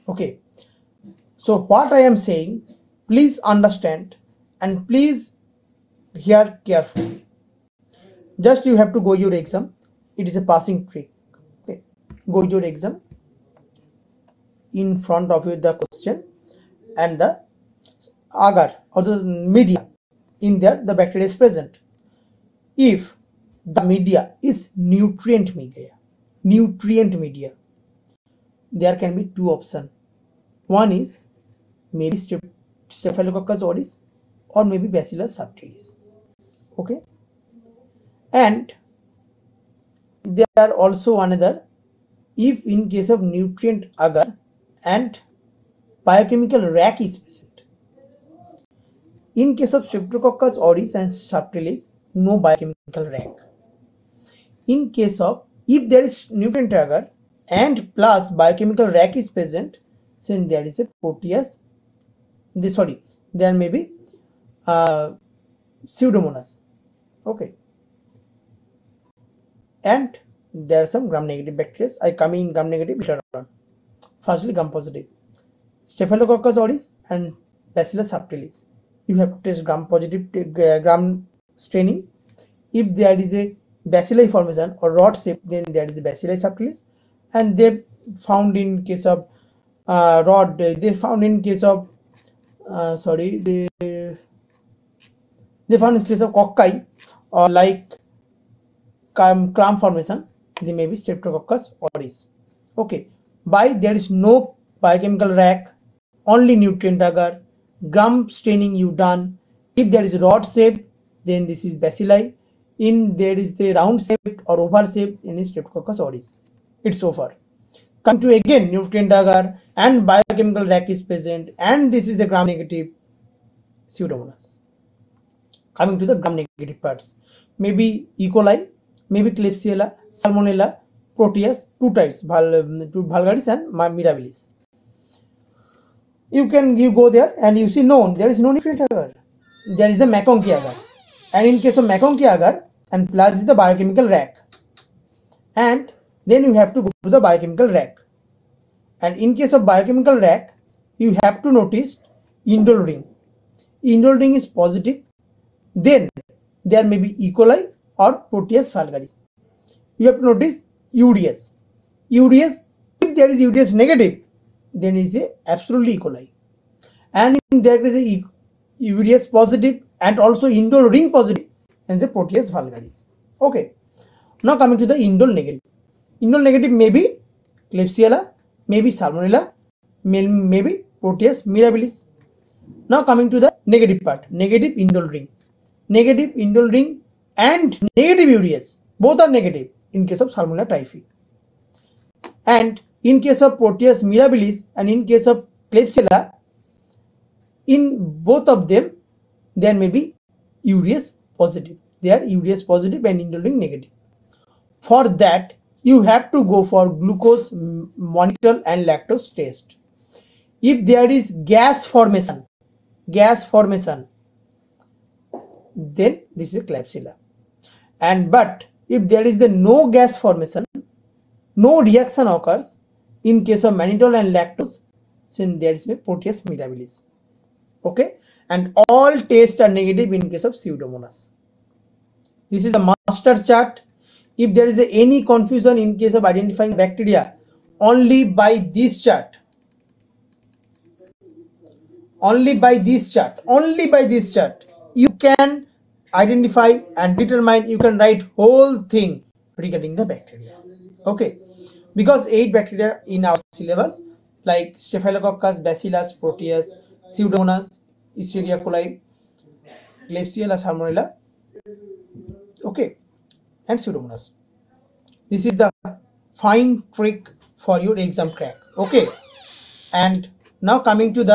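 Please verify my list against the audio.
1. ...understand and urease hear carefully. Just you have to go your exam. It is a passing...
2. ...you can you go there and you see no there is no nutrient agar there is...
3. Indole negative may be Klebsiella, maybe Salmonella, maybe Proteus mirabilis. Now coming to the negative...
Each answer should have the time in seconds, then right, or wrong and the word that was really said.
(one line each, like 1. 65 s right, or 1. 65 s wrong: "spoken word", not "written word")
1. 3 s wrong: "please", not "urease"
2. 136 s right
3. 176 s right.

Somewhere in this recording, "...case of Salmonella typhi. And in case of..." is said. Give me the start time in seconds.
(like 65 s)
190 s.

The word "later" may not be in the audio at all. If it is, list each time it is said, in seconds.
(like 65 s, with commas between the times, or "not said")
72 s.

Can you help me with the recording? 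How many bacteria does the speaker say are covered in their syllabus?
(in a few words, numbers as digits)
8.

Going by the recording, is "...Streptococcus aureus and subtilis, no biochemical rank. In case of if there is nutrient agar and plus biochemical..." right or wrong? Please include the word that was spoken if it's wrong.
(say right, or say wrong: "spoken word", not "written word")
right.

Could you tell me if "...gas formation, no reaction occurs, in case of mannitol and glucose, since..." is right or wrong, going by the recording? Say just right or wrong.
wrong.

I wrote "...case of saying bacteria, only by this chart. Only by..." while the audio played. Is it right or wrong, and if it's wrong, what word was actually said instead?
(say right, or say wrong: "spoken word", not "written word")
wrong: "identifying", not "saying".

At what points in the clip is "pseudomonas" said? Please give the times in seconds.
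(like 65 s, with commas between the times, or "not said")
65 s, 123 s, 230 s, 257 s, 263 s.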